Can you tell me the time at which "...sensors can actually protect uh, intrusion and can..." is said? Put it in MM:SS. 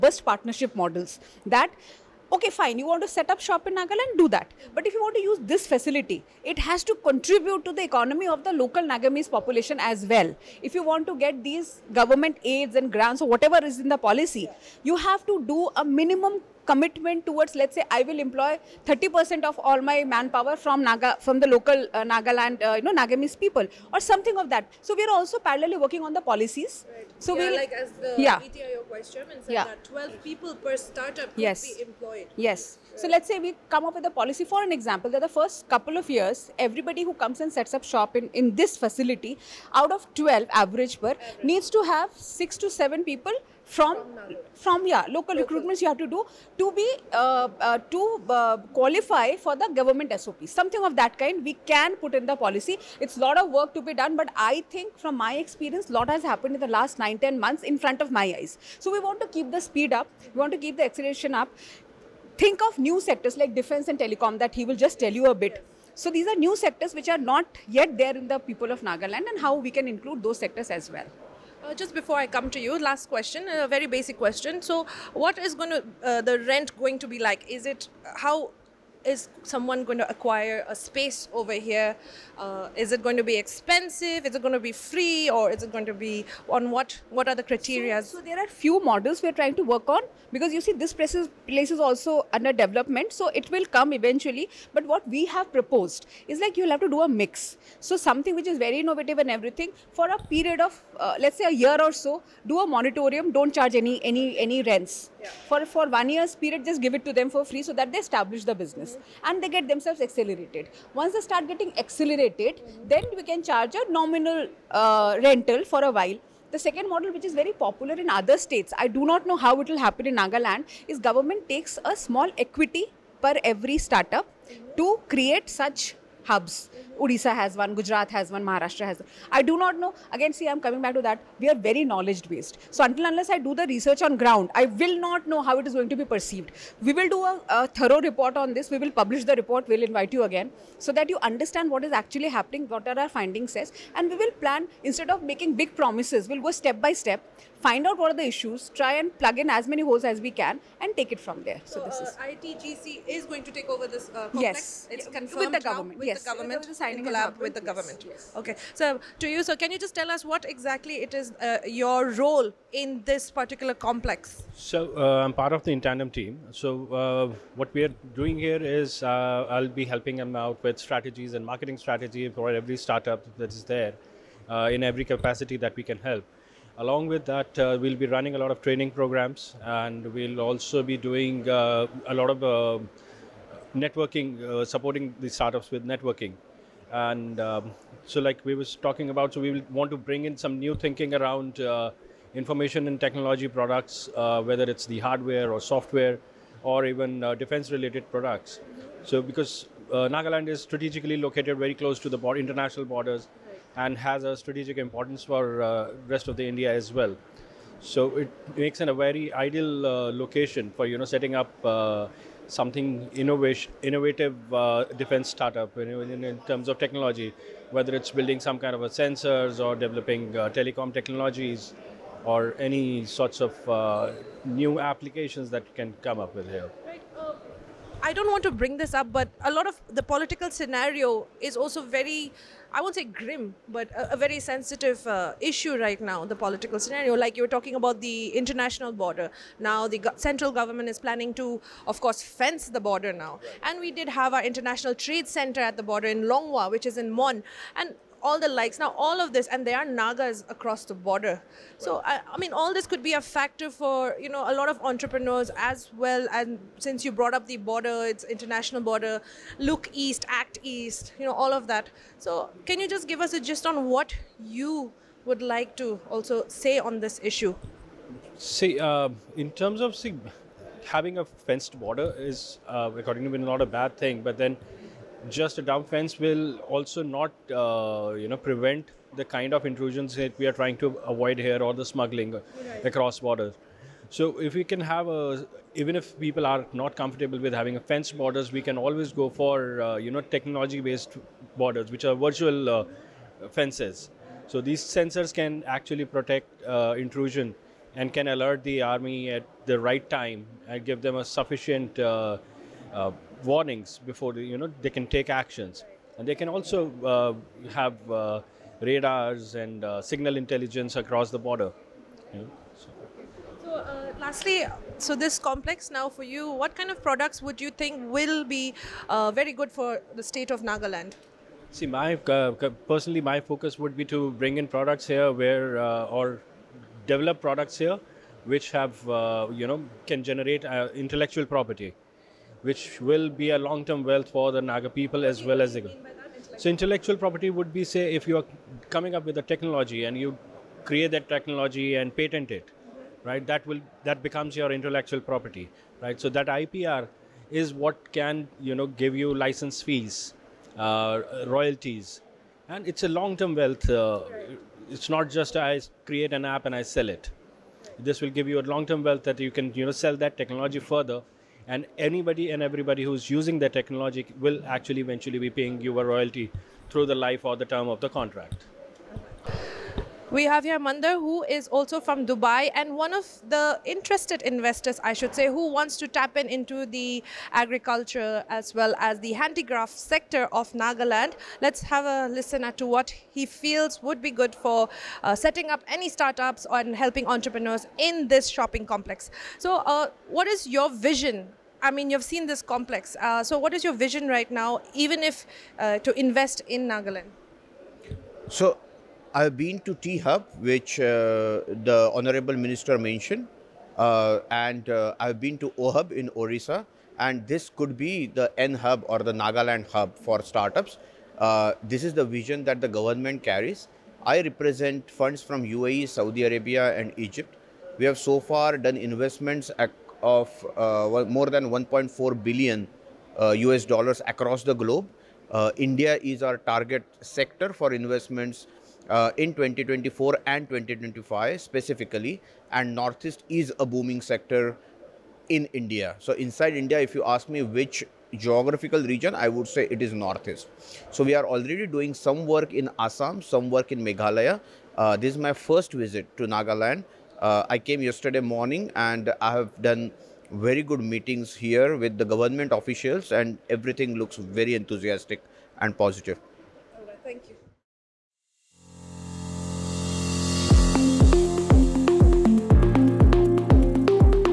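04:54.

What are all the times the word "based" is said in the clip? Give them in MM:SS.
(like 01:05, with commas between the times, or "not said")
02:12, 04:50.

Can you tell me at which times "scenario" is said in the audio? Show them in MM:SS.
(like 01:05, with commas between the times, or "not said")
03:50, 03:56.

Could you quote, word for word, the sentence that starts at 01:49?
and they get themselves accelerated once they start getting accelerated mm-hmm.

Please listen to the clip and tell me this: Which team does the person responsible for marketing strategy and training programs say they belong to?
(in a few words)
Intandem.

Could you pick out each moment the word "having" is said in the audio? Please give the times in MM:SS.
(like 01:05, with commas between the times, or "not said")
04:30, 04:47.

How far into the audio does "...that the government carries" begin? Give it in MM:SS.
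06:52.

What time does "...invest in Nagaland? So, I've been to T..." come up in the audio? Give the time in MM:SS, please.
06:36.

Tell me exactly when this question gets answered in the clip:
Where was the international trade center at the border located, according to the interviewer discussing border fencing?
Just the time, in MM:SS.
04:06.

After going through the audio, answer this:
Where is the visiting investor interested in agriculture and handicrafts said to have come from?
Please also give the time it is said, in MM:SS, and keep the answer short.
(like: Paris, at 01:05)
Dubai, at 06:12.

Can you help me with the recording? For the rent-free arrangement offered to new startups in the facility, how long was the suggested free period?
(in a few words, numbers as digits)
a year.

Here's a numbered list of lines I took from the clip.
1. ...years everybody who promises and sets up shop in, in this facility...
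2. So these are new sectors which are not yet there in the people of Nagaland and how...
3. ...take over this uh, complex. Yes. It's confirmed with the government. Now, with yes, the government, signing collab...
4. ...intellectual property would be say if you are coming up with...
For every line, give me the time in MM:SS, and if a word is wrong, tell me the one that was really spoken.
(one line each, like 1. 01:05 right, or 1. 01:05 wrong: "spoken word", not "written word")
1. 00:36 wrong: "comes", not "promises"
2. 01:05 right
3. 02:33 right
4. 05:36 right.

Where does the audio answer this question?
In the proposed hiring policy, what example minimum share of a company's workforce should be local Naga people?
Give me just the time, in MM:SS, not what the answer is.
00:18.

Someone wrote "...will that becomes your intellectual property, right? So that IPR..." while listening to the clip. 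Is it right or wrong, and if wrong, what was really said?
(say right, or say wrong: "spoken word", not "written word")
right.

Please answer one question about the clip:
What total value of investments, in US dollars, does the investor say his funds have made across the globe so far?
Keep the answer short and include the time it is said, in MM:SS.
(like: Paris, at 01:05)
1.4 billion, at 07:01.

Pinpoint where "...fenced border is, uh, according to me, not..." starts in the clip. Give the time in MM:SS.
04:31.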